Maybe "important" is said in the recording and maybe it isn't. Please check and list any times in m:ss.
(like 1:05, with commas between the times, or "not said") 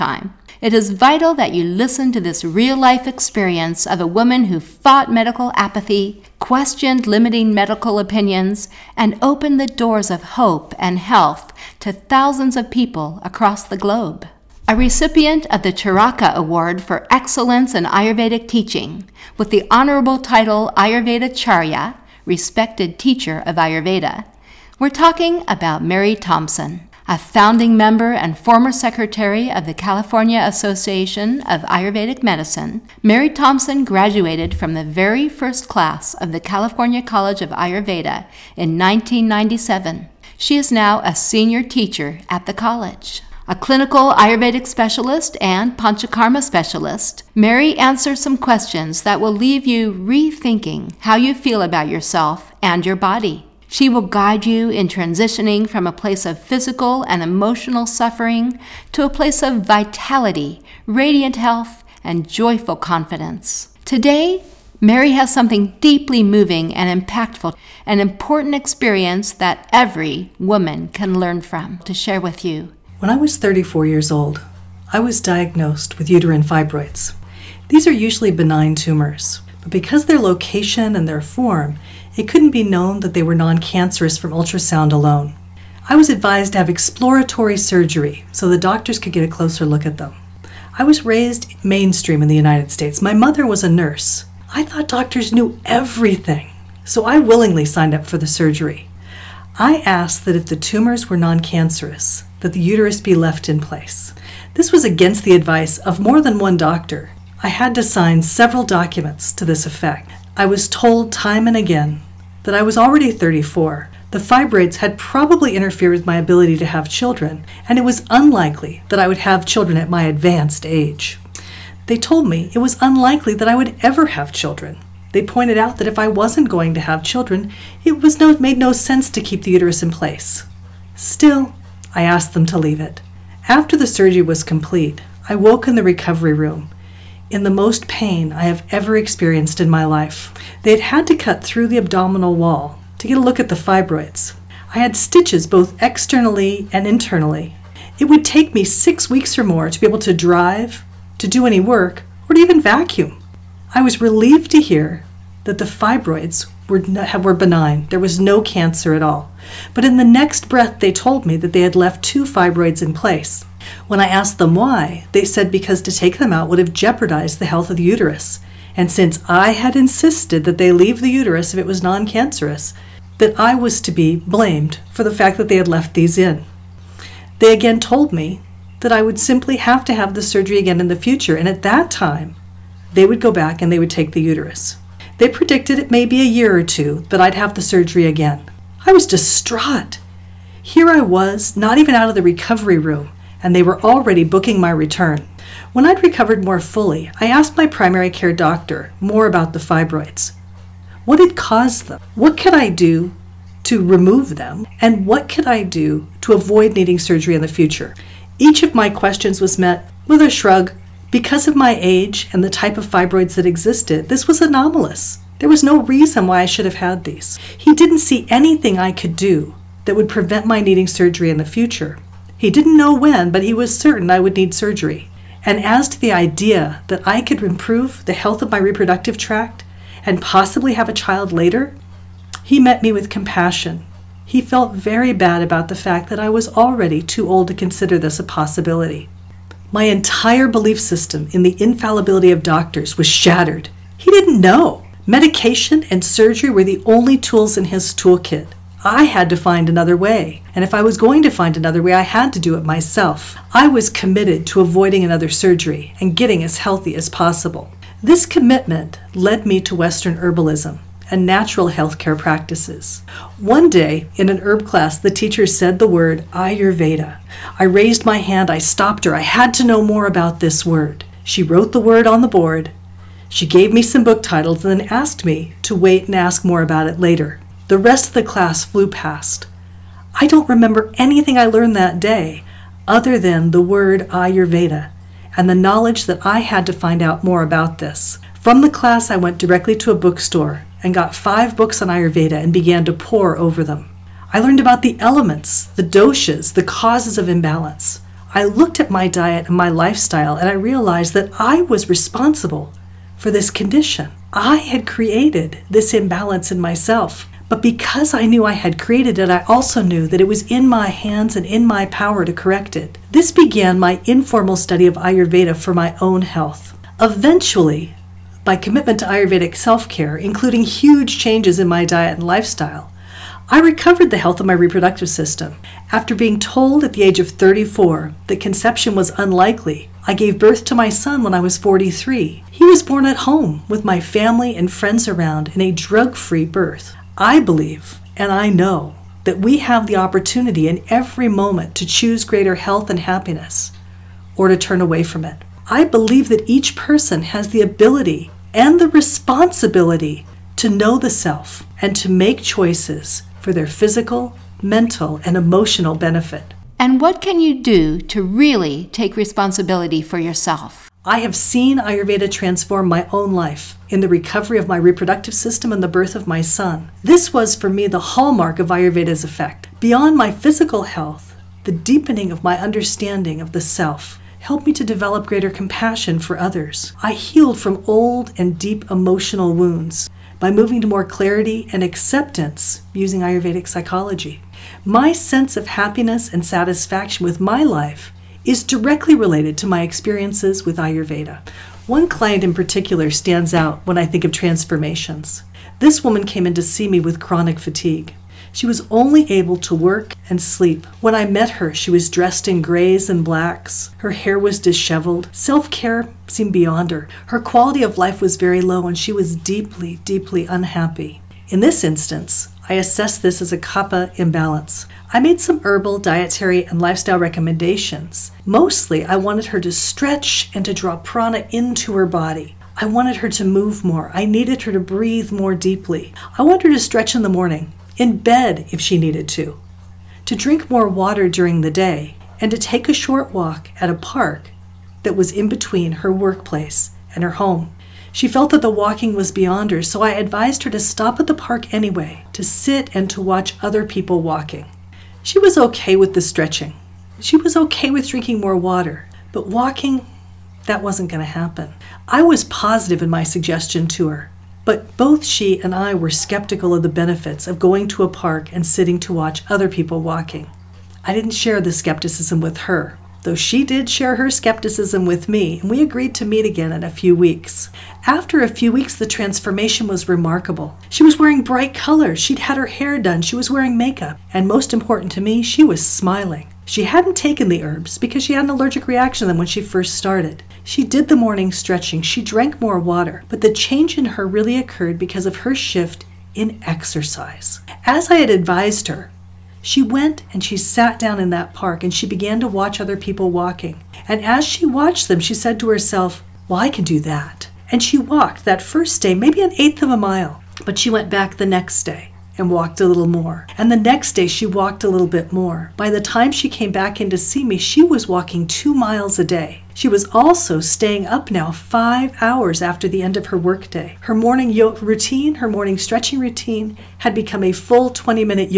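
1:08, 7:54.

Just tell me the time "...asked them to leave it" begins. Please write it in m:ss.
2:12.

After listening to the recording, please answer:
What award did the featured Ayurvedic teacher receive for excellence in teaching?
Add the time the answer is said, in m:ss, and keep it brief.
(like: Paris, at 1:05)
Charaka Award, at 0:15.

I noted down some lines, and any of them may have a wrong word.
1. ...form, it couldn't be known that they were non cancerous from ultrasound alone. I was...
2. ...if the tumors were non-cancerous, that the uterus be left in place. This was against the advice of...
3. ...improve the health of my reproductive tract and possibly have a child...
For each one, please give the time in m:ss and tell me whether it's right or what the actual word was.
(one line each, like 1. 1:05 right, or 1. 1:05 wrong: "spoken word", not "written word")
1. 1:21 right
2. 1:40 right
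3. 3:47 right.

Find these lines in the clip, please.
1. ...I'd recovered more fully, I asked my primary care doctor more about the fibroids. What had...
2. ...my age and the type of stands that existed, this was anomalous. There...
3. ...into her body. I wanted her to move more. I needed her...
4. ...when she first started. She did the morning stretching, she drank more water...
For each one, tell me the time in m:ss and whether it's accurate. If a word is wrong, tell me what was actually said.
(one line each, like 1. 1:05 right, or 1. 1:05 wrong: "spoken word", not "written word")
1. 3:15 right
2. 3:31 wrong: "fibroids", not "stands"
3. 7:01 right
4. 7:59 right.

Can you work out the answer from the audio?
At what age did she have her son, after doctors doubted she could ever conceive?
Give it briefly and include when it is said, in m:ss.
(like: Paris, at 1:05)
43, at 5:31.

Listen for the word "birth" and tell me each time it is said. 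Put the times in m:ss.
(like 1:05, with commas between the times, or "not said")
5:30, 5:36, 6:05.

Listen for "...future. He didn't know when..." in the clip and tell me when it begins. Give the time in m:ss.
3:41.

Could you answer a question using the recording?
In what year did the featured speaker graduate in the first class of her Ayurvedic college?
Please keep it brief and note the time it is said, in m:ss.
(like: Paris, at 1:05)
1997, at 0:38.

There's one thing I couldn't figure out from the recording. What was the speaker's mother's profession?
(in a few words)
nurse.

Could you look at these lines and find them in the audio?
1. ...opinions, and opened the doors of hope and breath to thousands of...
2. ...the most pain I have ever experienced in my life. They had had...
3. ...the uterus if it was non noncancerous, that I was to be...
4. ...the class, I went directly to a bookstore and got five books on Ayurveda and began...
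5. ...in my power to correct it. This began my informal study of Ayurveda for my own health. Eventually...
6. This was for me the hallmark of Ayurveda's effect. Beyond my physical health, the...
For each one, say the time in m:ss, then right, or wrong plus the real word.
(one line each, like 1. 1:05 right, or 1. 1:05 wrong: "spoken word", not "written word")
1. 0:07 wrong: "health", not "breath"
2. 2:17 right
3. 2:51 wrong: "cancerous", not "noncancerous"
4. 4:48 right
5. 5:11 right
6. 6:07 right.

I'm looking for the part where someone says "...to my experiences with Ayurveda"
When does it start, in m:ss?
6:29.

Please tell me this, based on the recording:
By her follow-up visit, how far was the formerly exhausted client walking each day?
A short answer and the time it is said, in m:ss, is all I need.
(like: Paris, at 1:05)
2 miles, at 8:28.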